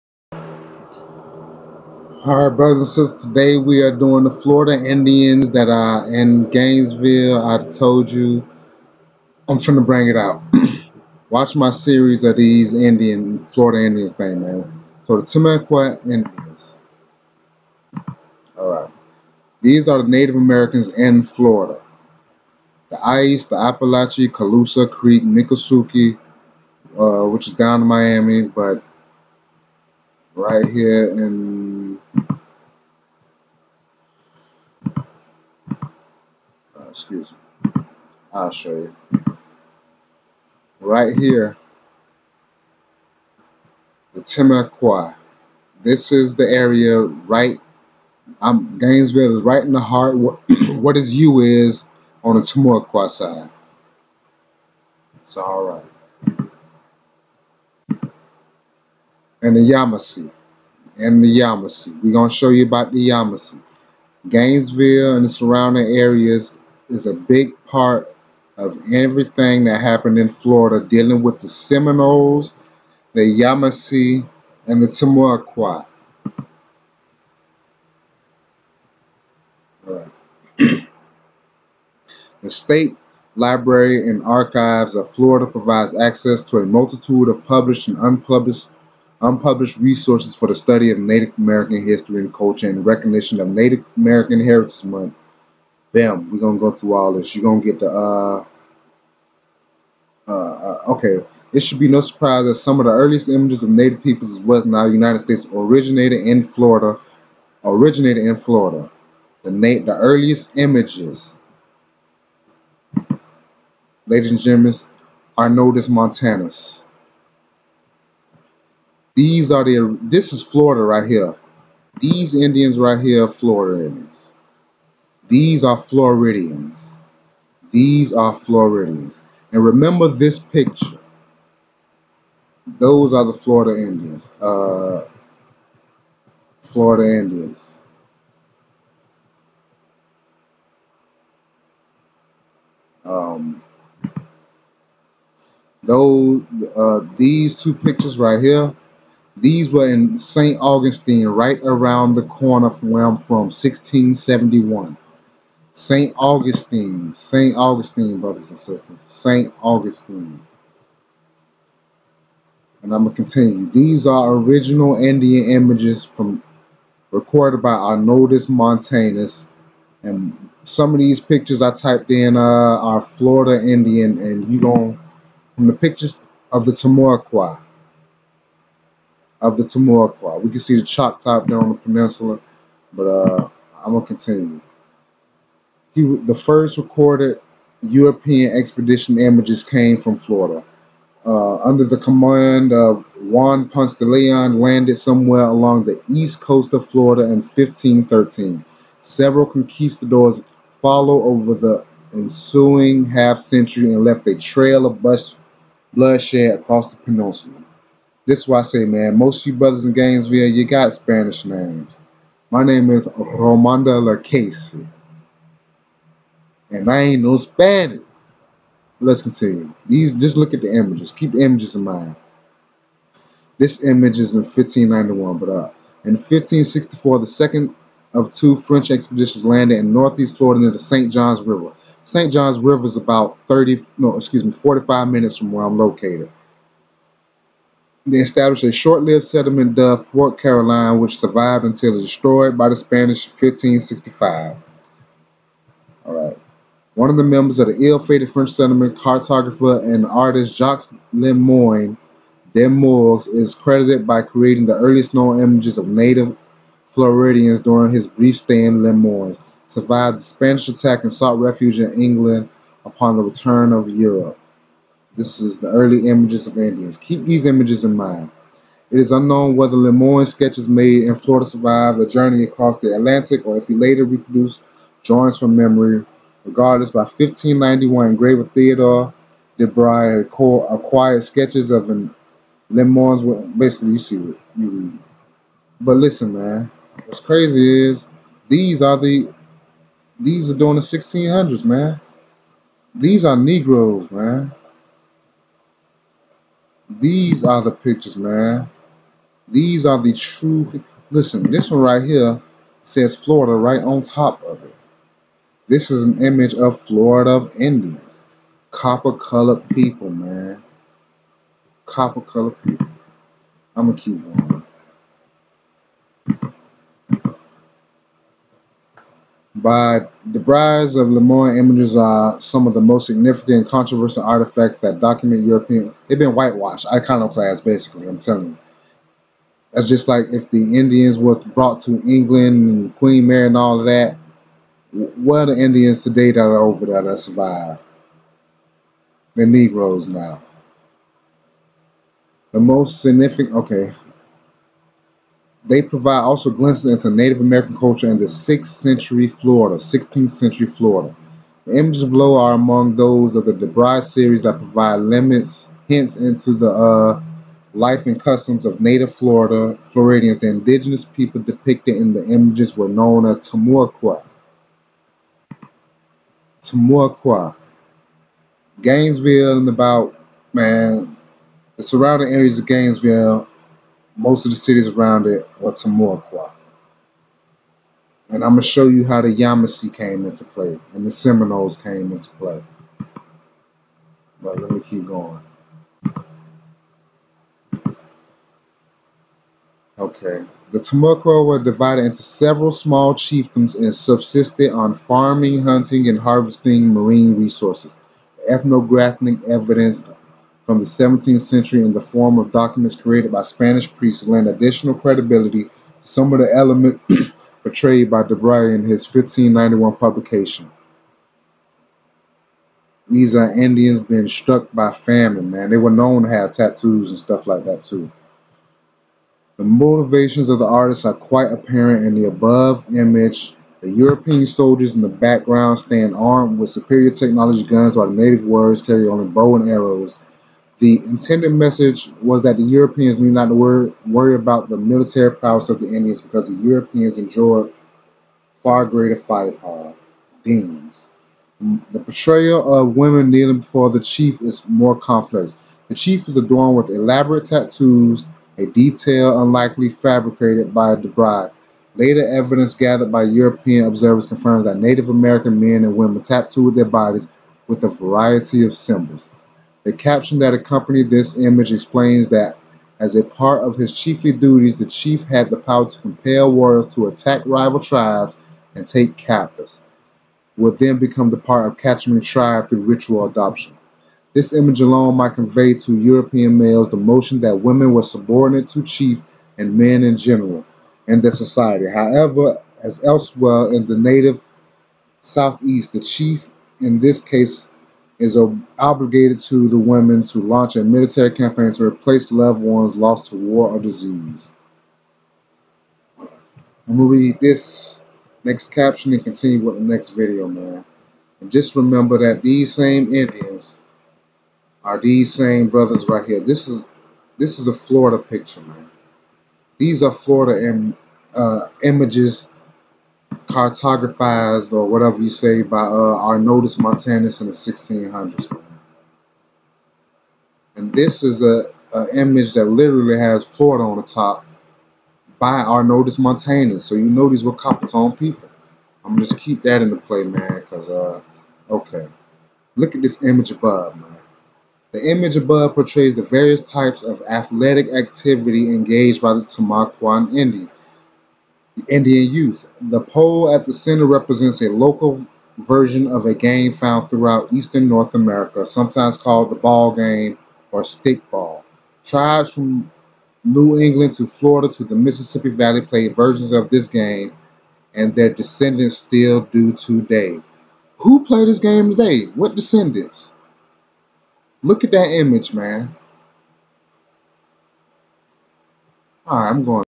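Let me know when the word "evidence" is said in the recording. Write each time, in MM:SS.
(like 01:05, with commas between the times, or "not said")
06:39, 07:32.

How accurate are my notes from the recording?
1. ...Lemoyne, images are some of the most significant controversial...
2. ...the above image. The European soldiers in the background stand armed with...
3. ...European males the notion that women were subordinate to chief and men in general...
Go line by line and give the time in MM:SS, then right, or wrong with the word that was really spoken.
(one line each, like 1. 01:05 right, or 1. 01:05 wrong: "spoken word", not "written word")
1. 05:21 right
2. 07:02 right
3. 07:55 right.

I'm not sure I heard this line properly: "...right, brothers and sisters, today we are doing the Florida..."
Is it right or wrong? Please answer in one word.
right.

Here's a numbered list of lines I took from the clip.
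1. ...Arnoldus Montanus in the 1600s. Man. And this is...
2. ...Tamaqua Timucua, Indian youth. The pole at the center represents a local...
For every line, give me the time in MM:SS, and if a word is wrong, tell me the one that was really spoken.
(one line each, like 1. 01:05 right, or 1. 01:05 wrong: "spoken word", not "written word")
1. 08:36 right
2. 08:59 wrong: "Indian", not "Timucua".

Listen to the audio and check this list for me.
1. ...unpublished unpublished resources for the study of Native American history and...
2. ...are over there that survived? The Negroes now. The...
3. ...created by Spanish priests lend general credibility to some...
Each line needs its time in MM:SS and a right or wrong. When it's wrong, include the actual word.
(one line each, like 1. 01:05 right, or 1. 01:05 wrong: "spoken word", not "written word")
1. 01:27 right
2. 05:36 right
3. 06:42 wrong: "additional", not "general".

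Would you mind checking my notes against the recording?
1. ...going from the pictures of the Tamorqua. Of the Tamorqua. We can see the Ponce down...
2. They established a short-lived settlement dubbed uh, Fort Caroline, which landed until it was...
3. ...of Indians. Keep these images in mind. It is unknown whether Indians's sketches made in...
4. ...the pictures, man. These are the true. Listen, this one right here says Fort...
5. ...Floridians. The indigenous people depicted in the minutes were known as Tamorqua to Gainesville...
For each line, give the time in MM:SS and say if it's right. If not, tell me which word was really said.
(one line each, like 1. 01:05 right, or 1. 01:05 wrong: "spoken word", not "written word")
1. 02:54 wrong: "Choctaw", not "Ponce"
2. 03:58 wrong: "survived", not "landed"
3. 04:26 wrong: "Lemoyne", not "Indians"
4. 04:57 wrong: "Florida", not "Fort"
5. 05:59 wrong: "images", not "minutes".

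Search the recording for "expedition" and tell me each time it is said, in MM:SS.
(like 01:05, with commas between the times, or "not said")
03:08, 03:48.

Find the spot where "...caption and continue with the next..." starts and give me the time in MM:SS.
08:18.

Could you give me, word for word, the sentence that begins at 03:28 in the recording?
This is why I say, man, most of you brothers in Gainesville, you got Spanish names.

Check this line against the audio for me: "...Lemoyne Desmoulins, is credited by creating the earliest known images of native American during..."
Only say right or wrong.
wrong.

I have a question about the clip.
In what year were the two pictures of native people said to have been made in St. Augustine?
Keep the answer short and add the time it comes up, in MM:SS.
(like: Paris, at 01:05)
1671, at 02:33.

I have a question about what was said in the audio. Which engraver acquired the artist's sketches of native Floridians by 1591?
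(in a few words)
Theodore de Bry.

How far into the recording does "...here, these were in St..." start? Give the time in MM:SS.
02:28.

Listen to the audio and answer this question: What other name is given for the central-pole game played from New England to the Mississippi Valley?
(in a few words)
stickball.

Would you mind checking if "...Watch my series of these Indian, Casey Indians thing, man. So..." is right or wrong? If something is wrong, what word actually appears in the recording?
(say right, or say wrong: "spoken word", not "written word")
wrong: "Florida", not "Casey".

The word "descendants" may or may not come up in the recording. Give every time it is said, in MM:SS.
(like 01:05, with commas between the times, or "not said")
09:18, 09:22.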